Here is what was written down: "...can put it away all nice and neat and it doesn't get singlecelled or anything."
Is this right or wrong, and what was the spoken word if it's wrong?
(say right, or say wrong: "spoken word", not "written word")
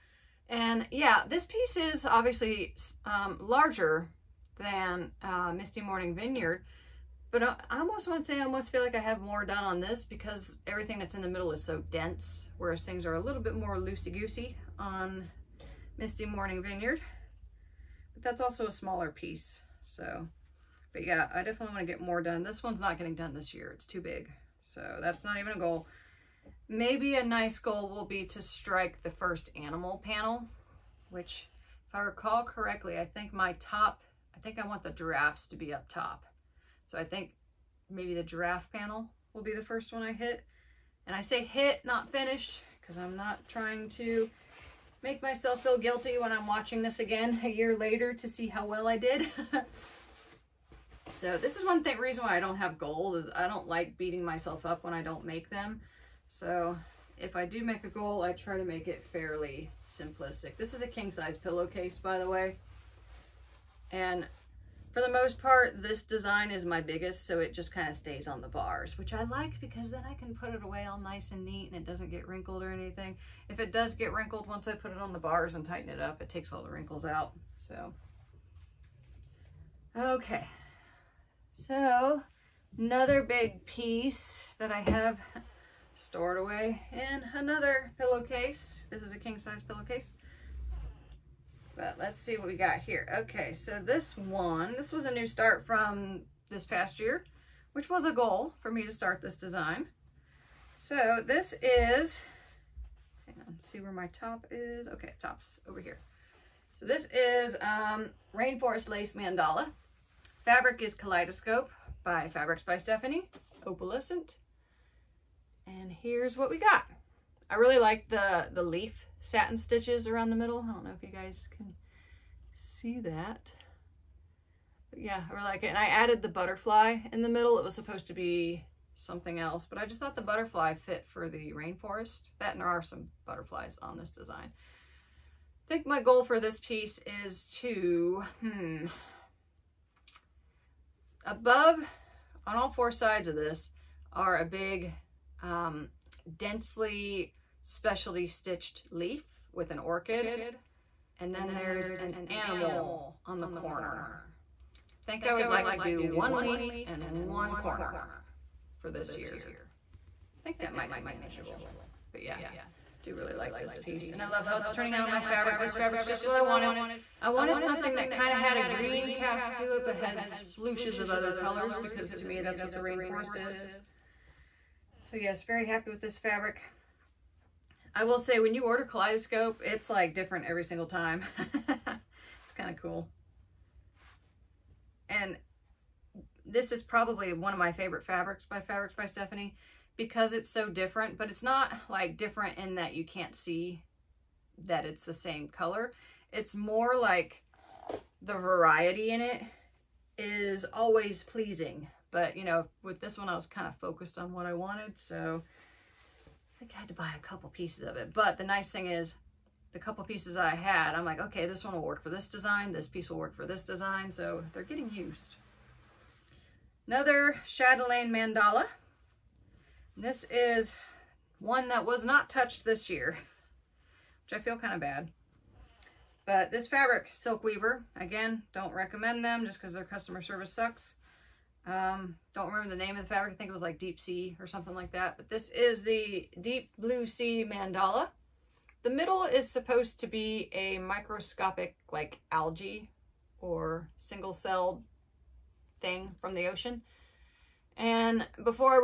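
wrong: "wrinkled", not "singlecelled".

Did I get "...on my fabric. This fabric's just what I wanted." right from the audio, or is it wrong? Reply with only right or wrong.
right.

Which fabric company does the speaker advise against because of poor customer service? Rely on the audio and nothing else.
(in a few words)
Silk Weaver.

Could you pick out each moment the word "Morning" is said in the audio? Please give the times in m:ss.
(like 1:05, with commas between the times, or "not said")
0:05, 0:16.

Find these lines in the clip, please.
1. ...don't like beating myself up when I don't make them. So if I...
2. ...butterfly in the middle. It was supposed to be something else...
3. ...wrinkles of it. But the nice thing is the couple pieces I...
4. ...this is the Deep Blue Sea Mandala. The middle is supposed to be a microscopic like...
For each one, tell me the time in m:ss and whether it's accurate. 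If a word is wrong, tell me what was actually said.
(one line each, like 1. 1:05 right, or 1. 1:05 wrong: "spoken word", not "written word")
1. 0:53 right
2. 2:06 right
3. 3:27 wrong: "pieces", not "wrinkles"
4. 3:55 right.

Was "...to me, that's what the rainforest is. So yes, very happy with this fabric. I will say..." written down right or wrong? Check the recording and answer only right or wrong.
right.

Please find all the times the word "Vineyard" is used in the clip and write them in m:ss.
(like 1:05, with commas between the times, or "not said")
0:06, 0:16.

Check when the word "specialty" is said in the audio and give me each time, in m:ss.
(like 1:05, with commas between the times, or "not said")
2:27.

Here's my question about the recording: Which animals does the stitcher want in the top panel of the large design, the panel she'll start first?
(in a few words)
Giraffes.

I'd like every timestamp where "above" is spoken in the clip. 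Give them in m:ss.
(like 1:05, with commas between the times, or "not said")
2:21.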